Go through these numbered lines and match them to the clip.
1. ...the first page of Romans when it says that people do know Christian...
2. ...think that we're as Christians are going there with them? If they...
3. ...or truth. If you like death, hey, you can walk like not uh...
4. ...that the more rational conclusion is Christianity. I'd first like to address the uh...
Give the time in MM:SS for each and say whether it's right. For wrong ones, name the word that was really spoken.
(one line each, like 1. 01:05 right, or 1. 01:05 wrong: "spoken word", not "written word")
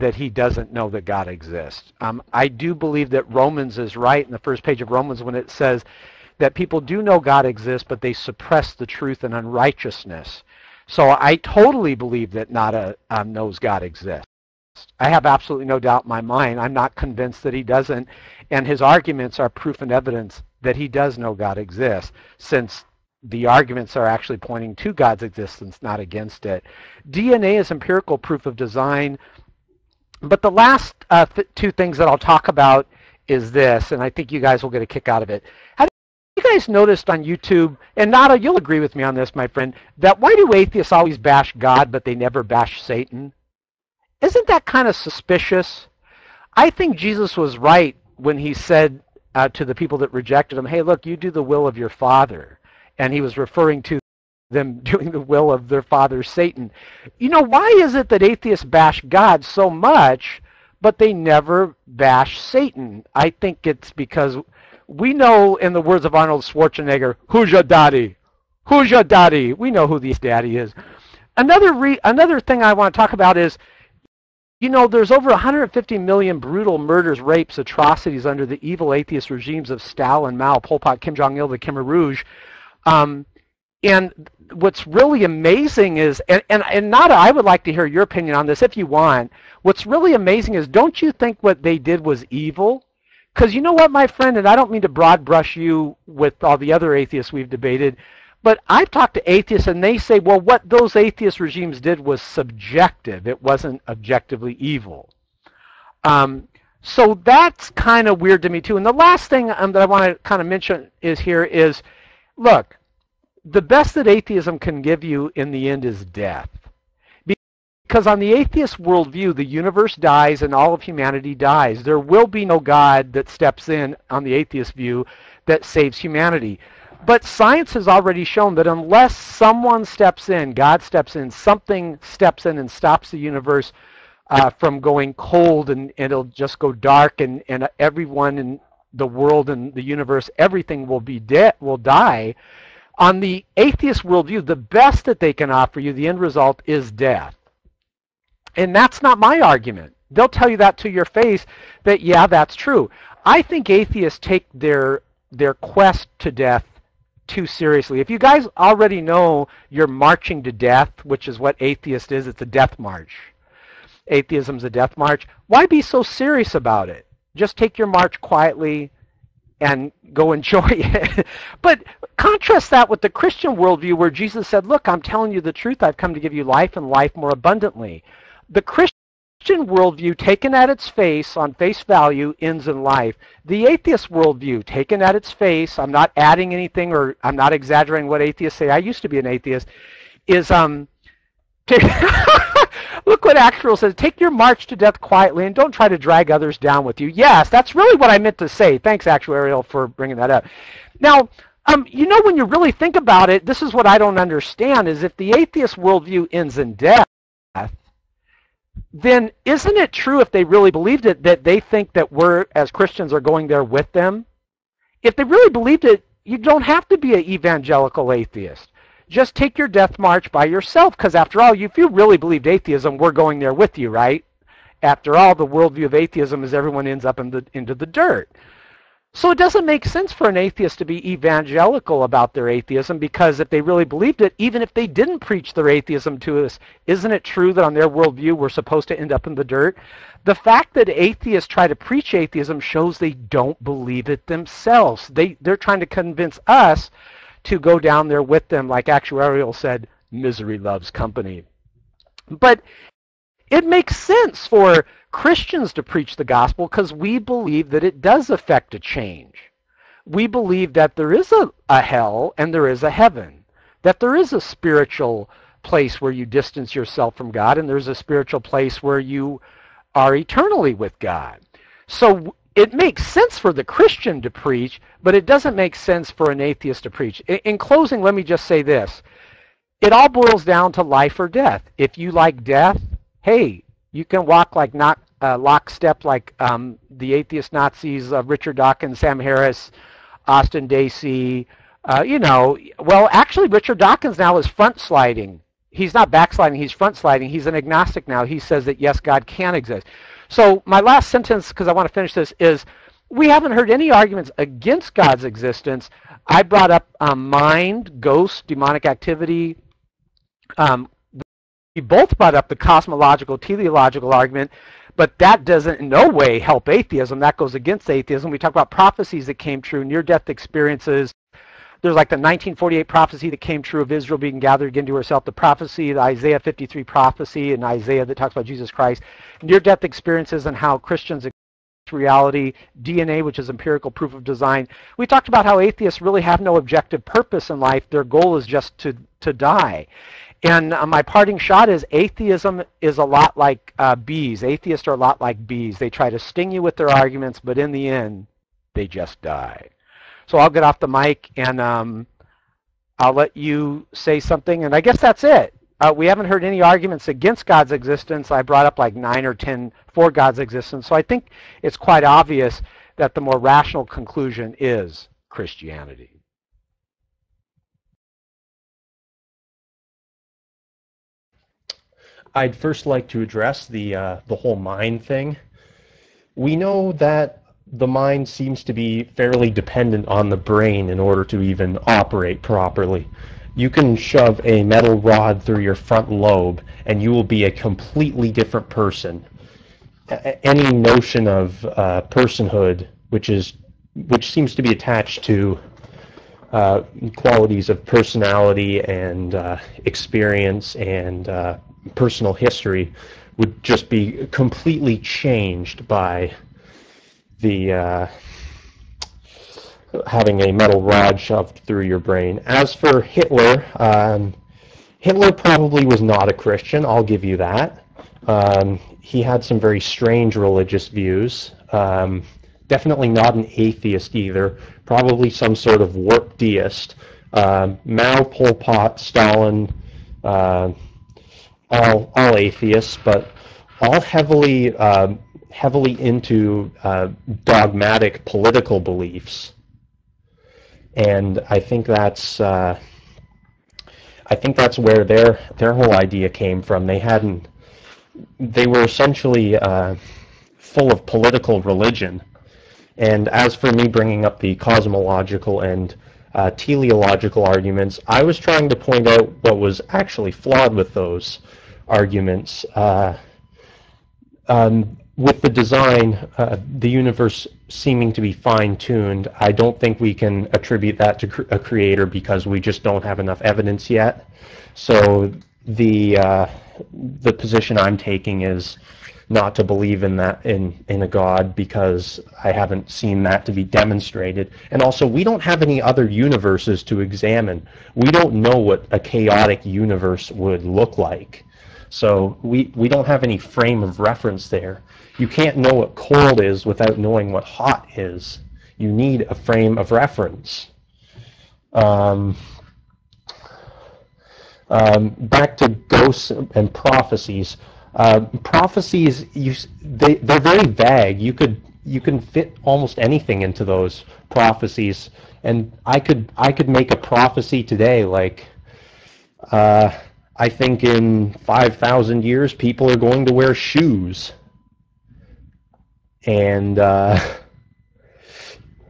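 1. 00:04 wrong: "God", not "Christian"
2. 03:31 right
3. 04:41 wrong: "death", not "truth"
4. 06:02 right.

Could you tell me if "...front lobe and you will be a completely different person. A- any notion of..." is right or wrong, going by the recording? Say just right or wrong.
right.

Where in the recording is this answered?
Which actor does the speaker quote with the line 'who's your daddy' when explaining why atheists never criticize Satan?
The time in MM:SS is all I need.
01:06.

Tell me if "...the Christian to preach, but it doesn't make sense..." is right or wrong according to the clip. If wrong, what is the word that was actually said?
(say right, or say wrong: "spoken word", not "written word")
right.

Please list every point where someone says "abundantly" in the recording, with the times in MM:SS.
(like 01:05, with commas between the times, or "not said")
02:57.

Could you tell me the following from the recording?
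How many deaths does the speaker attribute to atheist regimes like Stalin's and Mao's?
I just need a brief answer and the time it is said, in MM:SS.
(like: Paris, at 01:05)
150 million, at 01:15.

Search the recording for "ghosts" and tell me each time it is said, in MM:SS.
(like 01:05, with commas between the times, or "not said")
05:08, 08:25.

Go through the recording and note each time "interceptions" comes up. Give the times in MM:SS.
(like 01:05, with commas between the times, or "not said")
not said.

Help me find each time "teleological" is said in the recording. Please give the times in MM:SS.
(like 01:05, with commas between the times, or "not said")
05:13, 07:36.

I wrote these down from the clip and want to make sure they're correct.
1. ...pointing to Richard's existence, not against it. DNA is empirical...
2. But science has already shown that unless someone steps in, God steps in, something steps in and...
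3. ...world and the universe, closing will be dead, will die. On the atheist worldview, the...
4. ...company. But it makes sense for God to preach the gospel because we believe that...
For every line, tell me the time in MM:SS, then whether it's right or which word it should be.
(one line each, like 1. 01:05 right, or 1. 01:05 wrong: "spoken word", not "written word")
1. 00:24 wrong: "God", not "Richard"
2. 02:07 right
3. 02:19 wrong: "everything", not "closing"
4. 04:10 wrong: "Christians", not "God".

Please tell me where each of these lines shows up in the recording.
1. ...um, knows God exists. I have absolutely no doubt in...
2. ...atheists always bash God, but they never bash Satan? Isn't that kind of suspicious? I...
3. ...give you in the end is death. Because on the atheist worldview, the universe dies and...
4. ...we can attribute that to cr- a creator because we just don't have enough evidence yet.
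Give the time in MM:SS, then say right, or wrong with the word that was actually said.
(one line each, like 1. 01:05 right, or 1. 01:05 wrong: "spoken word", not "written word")
1. 00:13 right
2. 00:40 right
3. 01:54 right
4. 07:50 right.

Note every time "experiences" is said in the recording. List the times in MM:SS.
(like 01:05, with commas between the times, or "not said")
05:20, 05:29, 06:39.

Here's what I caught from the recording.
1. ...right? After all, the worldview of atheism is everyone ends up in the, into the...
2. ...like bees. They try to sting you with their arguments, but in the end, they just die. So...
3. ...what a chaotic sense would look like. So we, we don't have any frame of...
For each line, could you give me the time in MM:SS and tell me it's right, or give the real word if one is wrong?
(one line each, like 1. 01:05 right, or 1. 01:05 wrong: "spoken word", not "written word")
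1. 03:43 right
2. 05:45 right
3. 08:08 wrong: "universe", not "sense".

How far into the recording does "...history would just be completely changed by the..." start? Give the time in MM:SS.
06:42.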